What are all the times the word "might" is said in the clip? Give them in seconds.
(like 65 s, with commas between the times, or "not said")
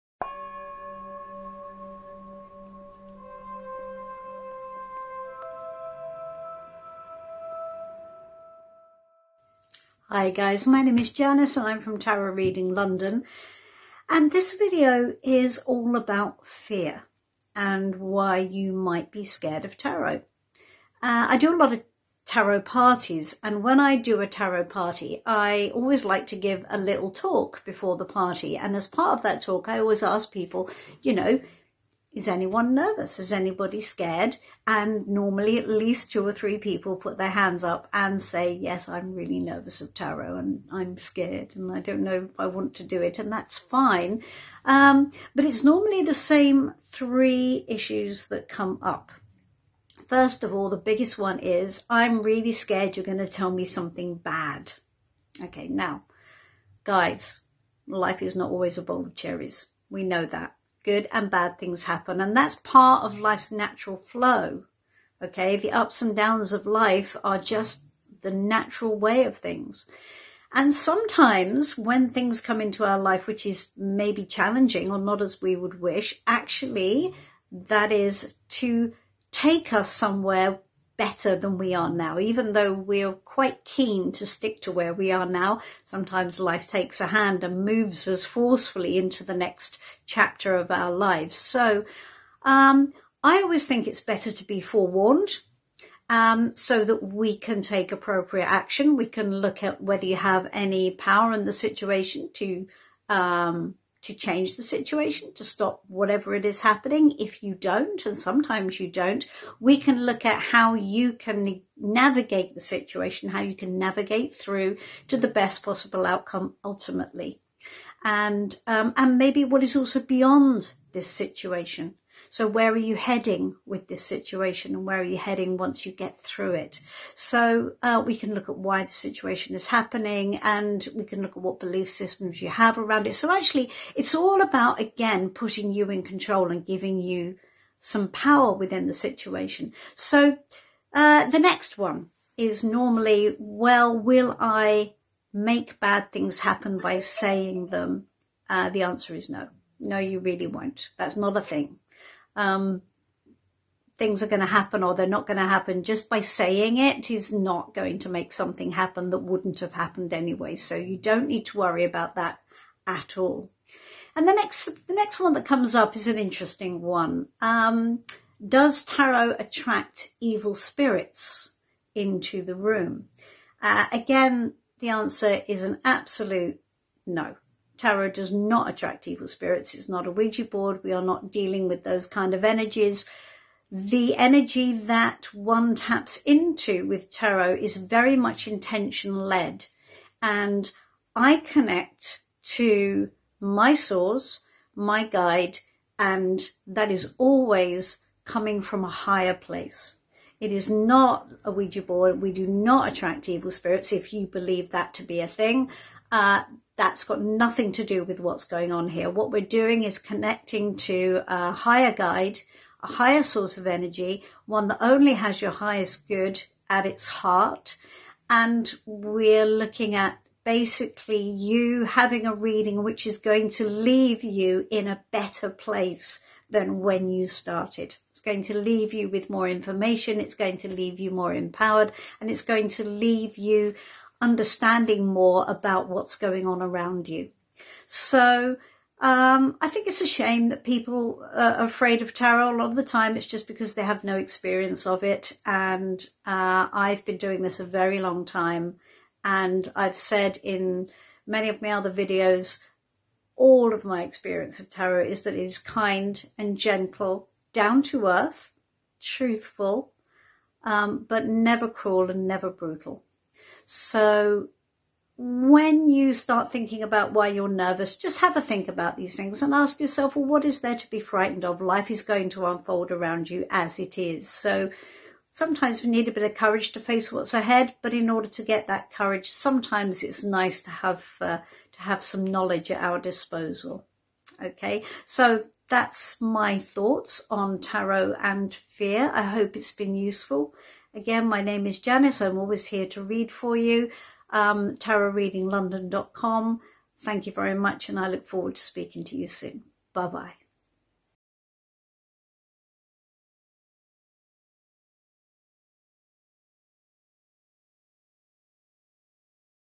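18 s.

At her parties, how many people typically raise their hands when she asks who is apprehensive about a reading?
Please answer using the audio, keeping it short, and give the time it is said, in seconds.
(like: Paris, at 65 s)
2 or 3, at 36 s.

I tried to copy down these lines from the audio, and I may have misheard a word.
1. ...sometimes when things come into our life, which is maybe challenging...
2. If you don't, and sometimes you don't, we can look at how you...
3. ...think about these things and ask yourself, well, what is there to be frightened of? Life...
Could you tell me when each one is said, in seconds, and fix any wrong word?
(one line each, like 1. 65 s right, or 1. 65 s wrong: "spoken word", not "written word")
1. 70 s right
2. 107 s right
3. 268 s right.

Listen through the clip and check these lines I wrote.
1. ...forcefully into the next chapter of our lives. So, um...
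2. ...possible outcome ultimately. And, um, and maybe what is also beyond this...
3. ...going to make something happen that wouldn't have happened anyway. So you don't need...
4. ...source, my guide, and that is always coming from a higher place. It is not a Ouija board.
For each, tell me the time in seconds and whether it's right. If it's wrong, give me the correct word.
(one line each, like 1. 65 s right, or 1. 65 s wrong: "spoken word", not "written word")
1. 88 s right
2. 115 s right
3. 157 s right
4. 193 s right.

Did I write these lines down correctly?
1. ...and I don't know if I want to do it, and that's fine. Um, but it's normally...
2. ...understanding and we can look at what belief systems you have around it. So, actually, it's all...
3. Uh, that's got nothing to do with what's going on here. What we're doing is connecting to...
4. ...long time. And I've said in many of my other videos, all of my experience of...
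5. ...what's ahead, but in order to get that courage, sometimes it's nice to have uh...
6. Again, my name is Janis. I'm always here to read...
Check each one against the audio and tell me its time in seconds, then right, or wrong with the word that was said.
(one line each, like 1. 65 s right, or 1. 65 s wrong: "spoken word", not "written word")
1. 41 s right
2. 129 s wrong: "happening", not "understanding"
3. 206 s right
4. 247 s right
5. 277 s right
6. 290 s right.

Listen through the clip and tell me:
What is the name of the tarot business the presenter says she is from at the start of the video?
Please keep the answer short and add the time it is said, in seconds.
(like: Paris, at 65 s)
Tarot Reading London, at 11 s.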